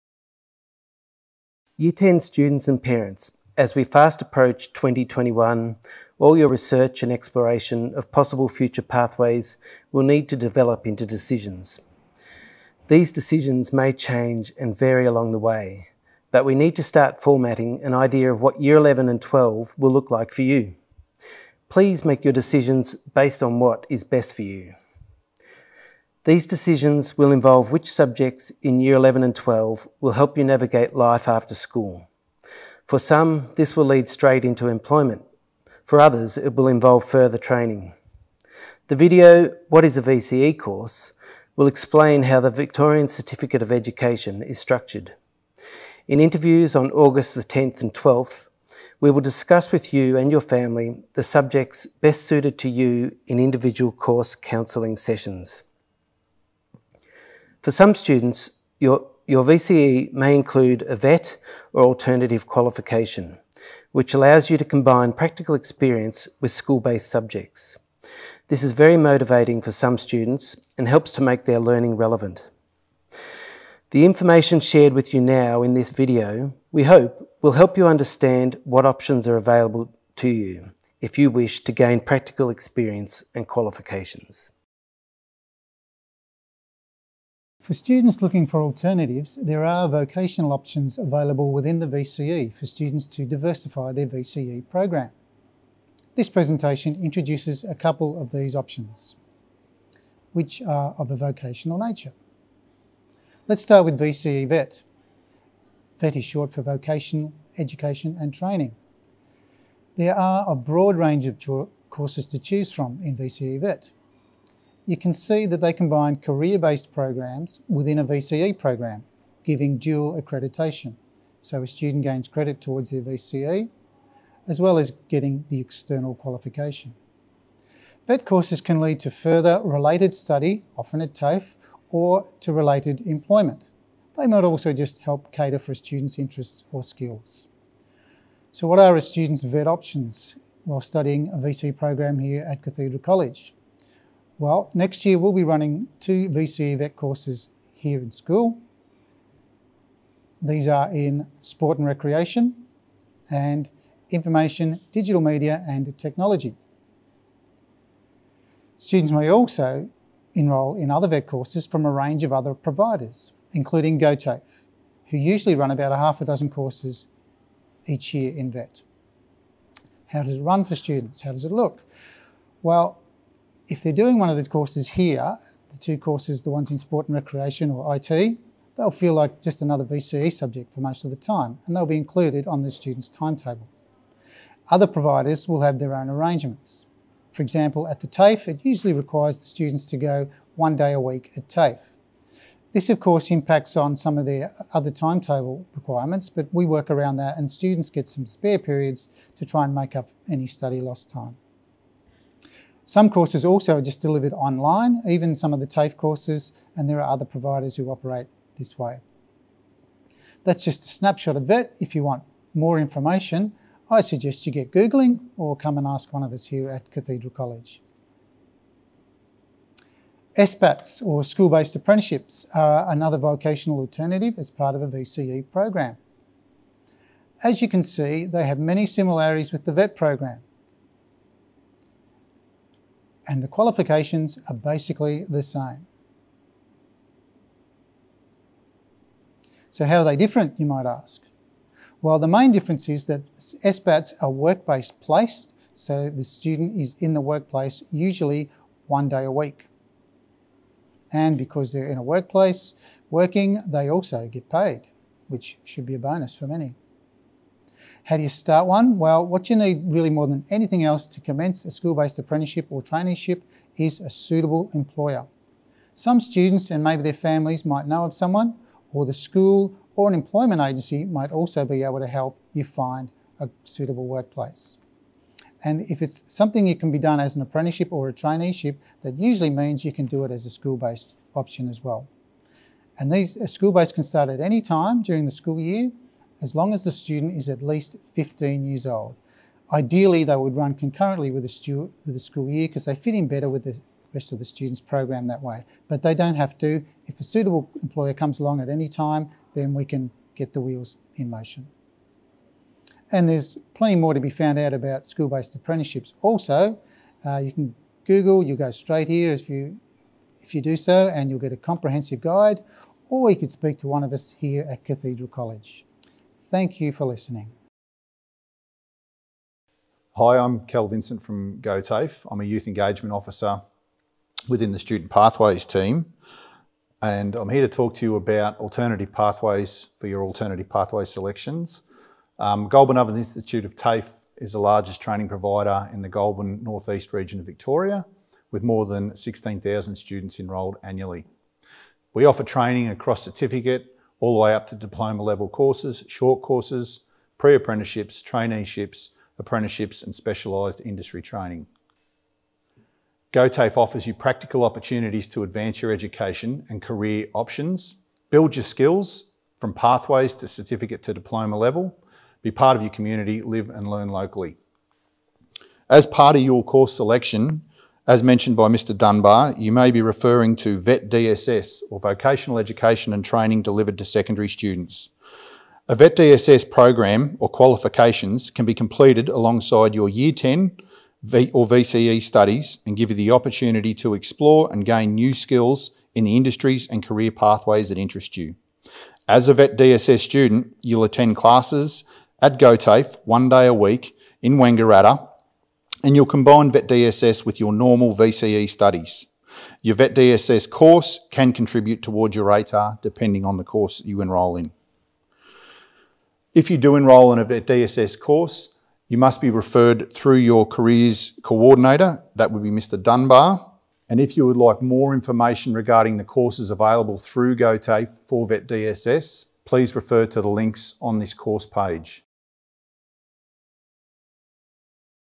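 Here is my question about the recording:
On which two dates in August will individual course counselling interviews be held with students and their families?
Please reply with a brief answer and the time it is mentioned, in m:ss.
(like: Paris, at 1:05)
August 10 and 12, at 0:46.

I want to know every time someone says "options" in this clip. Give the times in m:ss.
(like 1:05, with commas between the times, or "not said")
1:18, 1:30, 1:38, 2:19, 4:41, 5:57.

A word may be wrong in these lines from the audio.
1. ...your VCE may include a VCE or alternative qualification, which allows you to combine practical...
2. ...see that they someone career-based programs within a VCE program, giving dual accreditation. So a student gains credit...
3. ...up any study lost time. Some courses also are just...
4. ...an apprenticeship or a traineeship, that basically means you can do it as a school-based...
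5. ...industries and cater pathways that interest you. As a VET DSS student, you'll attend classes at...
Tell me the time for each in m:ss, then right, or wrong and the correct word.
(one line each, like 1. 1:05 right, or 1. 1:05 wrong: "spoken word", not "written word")
1. 0:59 wrong: "VET", not "VCE"
2. 1:55 wrong: "combine", not "someone"
3. 3:19 right
4. 4:37 wrong: "usually", not "basically"
5. 6:26 wrong: "career", not "cater".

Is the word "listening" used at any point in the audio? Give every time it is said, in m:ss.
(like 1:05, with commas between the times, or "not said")
5:17.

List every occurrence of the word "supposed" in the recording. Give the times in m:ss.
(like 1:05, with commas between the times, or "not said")
not said.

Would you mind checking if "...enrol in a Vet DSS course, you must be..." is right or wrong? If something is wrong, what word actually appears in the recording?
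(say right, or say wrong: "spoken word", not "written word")
right.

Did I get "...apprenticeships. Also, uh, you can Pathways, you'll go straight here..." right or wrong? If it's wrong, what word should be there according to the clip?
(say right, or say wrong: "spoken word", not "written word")
wrong: "Google", not "Pathways".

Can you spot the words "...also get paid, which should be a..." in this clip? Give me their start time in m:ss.
4:13.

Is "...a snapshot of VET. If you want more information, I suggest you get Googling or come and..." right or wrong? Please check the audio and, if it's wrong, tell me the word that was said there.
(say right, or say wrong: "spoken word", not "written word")
right.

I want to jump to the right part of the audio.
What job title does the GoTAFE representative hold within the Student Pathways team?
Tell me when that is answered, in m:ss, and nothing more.
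5:22.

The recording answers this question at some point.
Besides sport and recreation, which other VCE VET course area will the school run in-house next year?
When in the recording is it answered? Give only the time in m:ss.
2:34.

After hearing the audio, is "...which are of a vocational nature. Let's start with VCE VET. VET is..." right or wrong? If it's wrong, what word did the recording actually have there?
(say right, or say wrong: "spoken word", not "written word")
right.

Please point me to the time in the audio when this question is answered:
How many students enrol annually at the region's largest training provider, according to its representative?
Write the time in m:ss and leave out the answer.
5:38.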